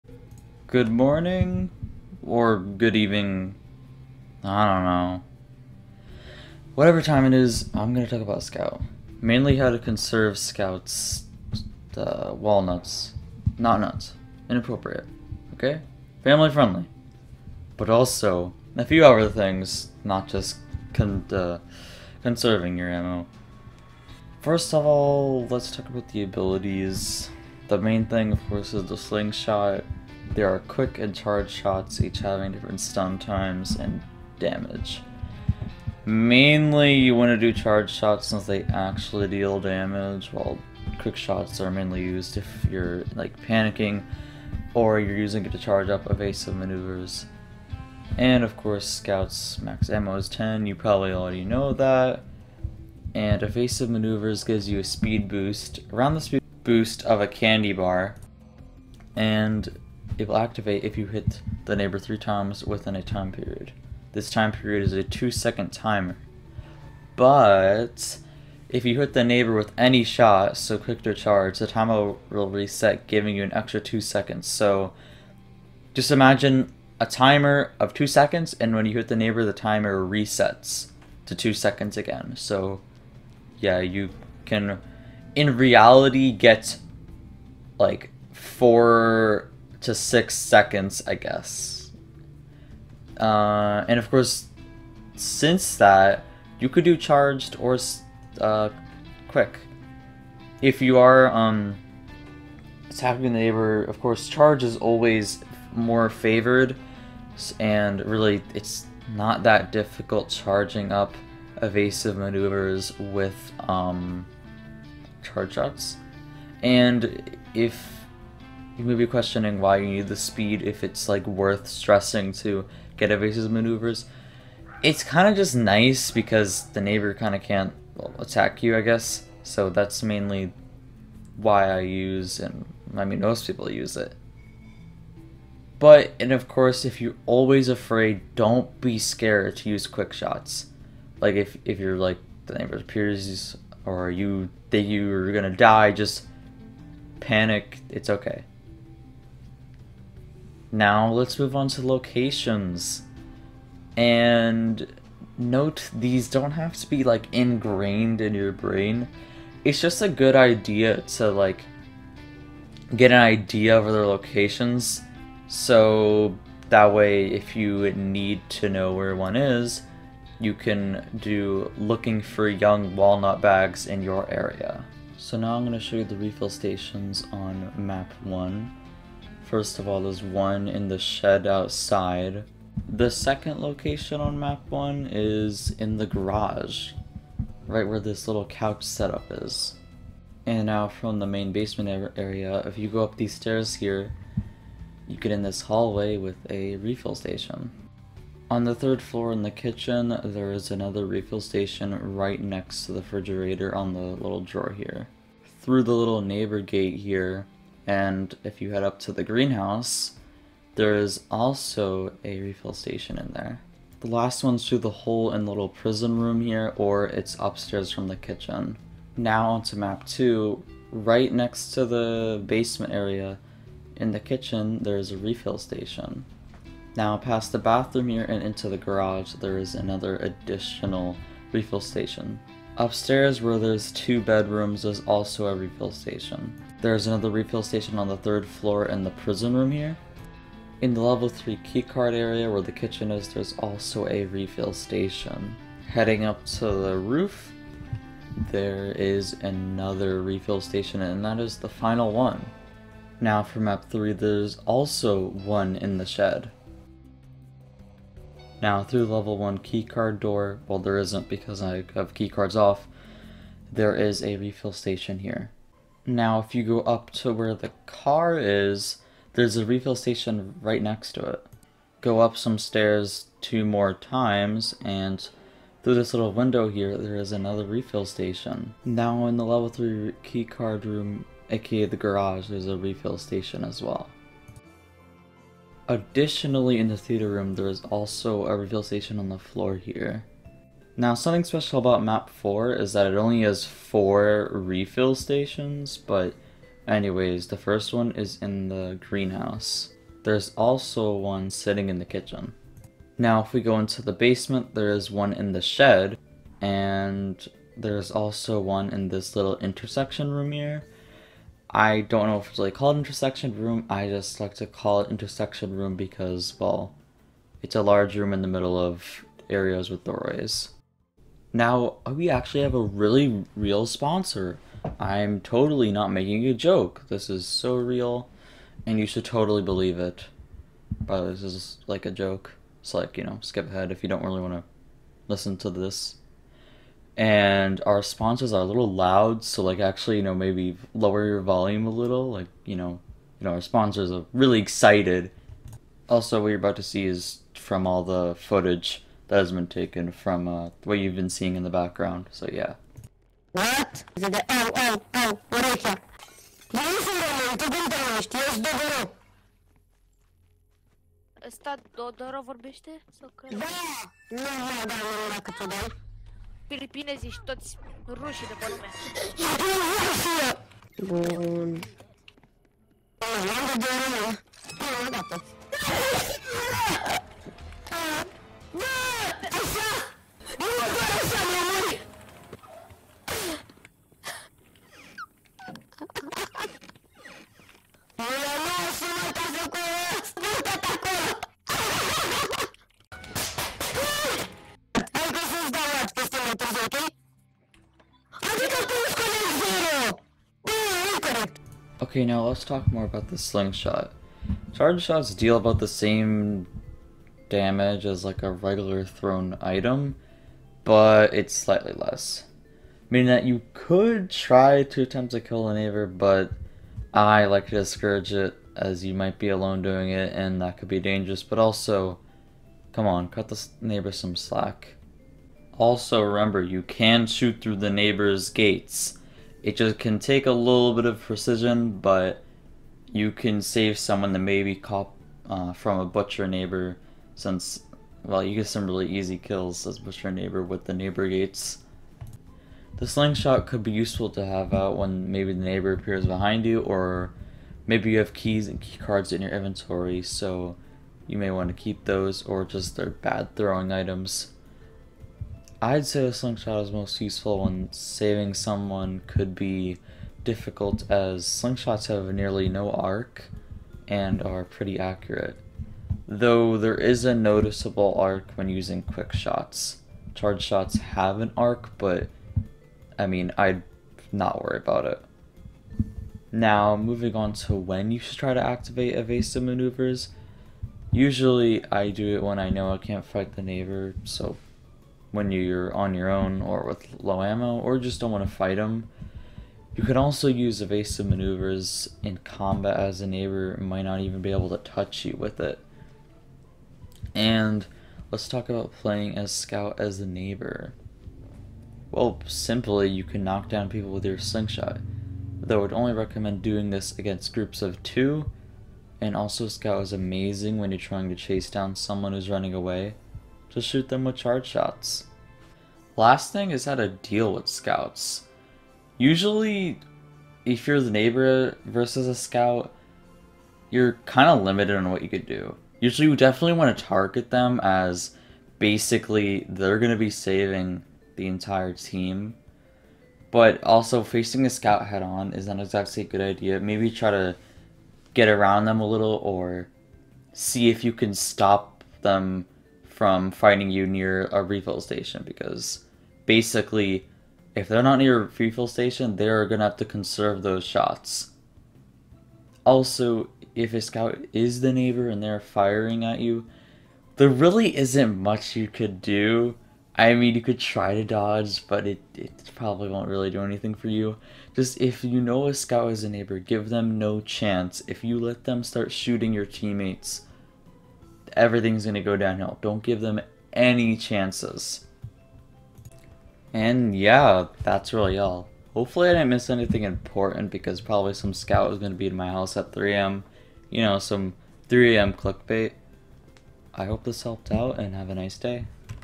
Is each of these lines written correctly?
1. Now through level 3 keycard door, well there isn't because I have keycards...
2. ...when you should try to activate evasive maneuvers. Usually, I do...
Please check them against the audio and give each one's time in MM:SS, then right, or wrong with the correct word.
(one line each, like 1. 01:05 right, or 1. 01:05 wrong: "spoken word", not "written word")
1. 04:18 wrong: "1", not "3"
2. 07:57 right.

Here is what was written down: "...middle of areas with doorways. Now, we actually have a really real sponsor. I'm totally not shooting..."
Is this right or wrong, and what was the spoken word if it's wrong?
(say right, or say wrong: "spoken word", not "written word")
wrong: "making", not "shooting".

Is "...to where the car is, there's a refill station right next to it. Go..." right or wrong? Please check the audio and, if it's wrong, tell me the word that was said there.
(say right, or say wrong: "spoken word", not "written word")
right.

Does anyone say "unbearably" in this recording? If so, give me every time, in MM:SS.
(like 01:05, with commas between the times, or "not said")
not said.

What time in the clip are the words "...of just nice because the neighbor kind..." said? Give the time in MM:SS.
02:05.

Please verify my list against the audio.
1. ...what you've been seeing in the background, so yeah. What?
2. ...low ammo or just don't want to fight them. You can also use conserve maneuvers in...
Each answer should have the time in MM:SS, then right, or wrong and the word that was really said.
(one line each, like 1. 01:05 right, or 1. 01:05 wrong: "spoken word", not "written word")
1. 05:50 right
2. 08:07 wrong: "evasive", not "conserve".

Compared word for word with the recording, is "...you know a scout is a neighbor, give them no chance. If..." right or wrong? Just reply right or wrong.
right.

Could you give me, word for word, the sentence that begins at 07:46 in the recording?
Though there is a noticeable arc when using quick shots.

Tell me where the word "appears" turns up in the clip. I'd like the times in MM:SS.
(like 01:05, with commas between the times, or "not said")
02:22, 07:25.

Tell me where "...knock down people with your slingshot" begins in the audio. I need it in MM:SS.
08:23.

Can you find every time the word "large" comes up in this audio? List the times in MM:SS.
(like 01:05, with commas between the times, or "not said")
05:17.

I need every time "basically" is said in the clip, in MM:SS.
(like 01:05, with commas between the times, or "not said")
08:48, 09:06.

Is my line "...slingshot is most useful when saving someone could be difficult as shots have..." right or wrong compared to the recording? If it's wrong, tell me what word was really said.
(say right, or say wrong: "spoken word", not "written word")
wrong: "slingshots", not "shots".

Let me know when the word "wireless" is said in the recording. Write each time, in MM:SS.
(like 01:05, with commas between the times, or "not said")
not said.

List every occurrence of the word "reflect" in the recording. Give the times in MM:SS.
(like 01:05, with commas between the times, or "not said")
not said.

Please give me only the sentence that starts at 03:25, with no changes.
Through the little neighbor gate here, and if you head up to the greenhouse, there is also a refill station in there.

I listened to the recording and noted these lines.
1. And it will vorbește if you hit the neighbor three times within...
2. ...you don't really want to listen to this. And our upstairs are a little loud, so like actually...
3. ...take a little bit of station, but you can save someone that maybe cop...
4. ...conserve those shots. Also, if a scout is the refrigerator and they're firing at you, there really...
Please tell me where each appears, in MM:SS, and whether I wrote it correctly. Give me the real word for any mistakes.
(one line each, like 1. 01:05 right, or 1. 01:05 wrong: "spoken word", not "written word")
1. 00:59 wrong: "activate", not "vorbește"
2. 05:34 wrong: "sponsors", not "upstairs"
3. 07:10 wrong: "precision", not "station"
4. 09:10 wrong: "neighbor", not "refrigerator".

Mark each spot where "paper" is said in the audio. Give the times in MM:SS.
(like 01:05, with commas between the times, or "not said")
not said.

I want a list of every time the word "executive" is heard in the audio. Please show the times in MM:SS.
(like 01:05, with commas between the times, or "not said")
not said.